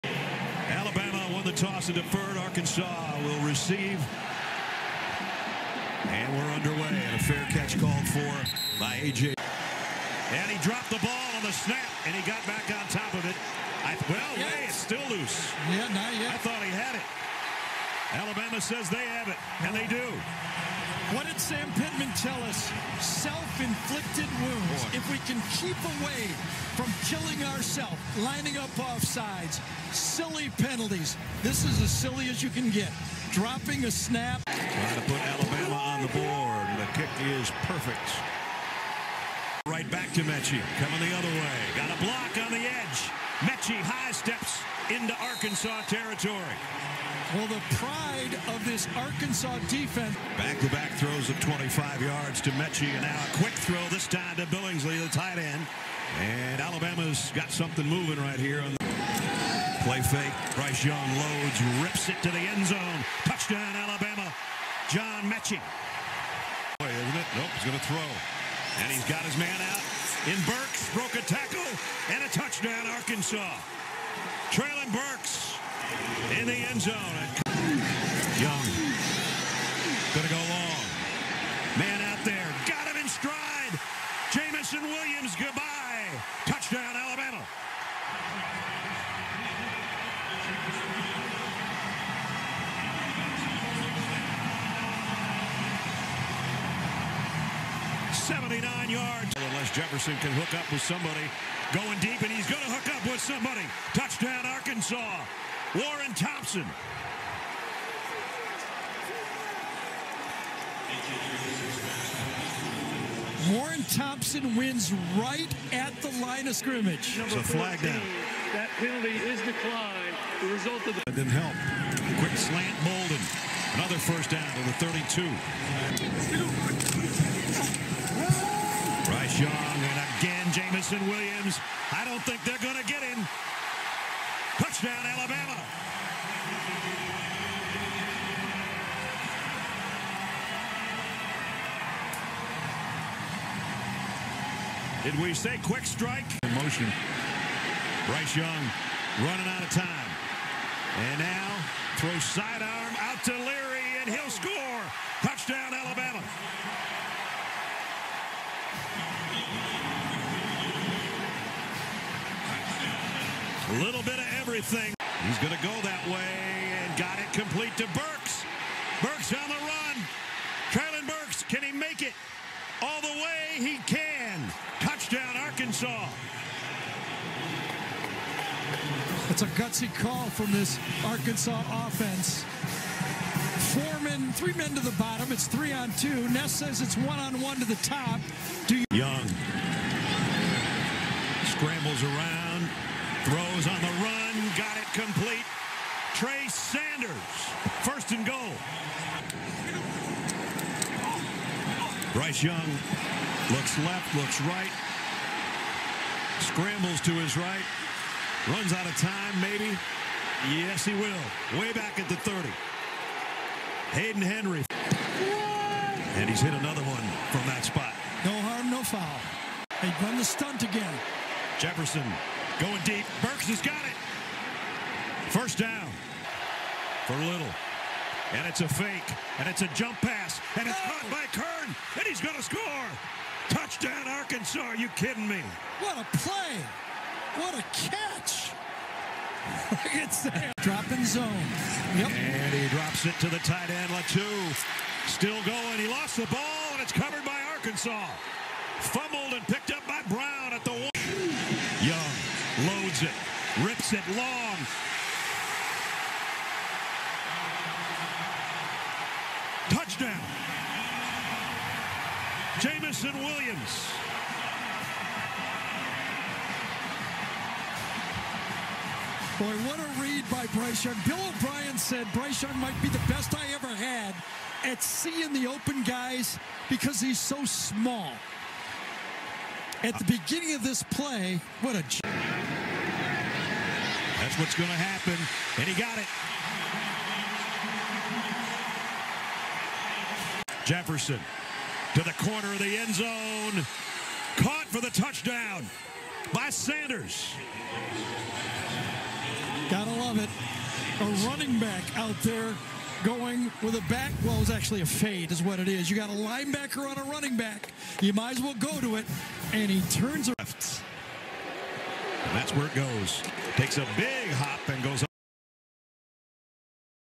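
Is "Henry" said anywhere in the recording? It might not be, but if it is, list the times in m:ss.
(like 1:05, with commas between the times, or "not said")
3:34.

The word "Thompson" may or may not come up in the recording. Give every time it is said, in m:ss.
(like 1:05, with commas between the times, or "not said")
1:46, 1:53.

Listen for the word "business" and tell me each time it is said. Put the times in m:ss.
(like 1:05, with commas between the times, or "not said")
not said.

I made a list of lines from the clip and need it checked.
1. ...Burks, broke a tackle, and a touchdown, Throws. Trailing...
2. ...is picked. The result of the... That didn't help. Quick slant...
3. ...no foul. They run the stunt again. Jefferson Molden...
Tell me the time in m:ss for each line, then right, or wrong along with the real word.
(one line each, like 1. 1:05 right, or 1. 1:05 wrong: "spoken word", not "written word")
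1. 1:10 wrong: "Arkansas", not "Throws"
2. 1:59 wrong: "declined", not "picked"
3. 3:38 wrong: "Going", not "Molden".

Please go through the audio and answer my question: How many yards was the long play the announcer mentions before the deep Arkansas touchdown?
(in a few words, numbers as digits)
79.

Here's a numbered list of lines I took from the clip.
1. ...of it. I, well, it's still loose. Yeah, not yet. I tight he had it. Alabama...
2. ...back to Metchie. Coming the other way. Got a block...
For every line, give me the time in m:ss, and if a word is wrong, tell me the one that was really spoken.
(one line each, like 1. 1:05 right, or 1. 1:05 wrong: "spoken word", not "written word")
1. 0:13 wrong: "thought", not "tight"
2. 0:39 right.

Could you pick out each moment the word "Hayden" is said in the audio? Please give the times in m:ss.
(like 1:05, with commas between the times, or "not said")
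3:33.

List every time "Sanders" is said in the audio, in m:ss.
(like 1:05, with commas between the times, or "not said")
3:16, 4:56.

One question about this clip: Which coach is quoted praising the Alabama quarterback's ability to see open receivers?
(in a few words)
Bill O'Brien.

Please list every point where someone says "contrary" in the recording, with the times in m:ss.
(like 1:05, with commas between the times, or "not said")
not said.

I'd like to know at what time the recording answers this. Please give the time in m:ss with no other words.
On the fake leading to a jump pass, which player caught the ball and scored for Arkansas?
3:51.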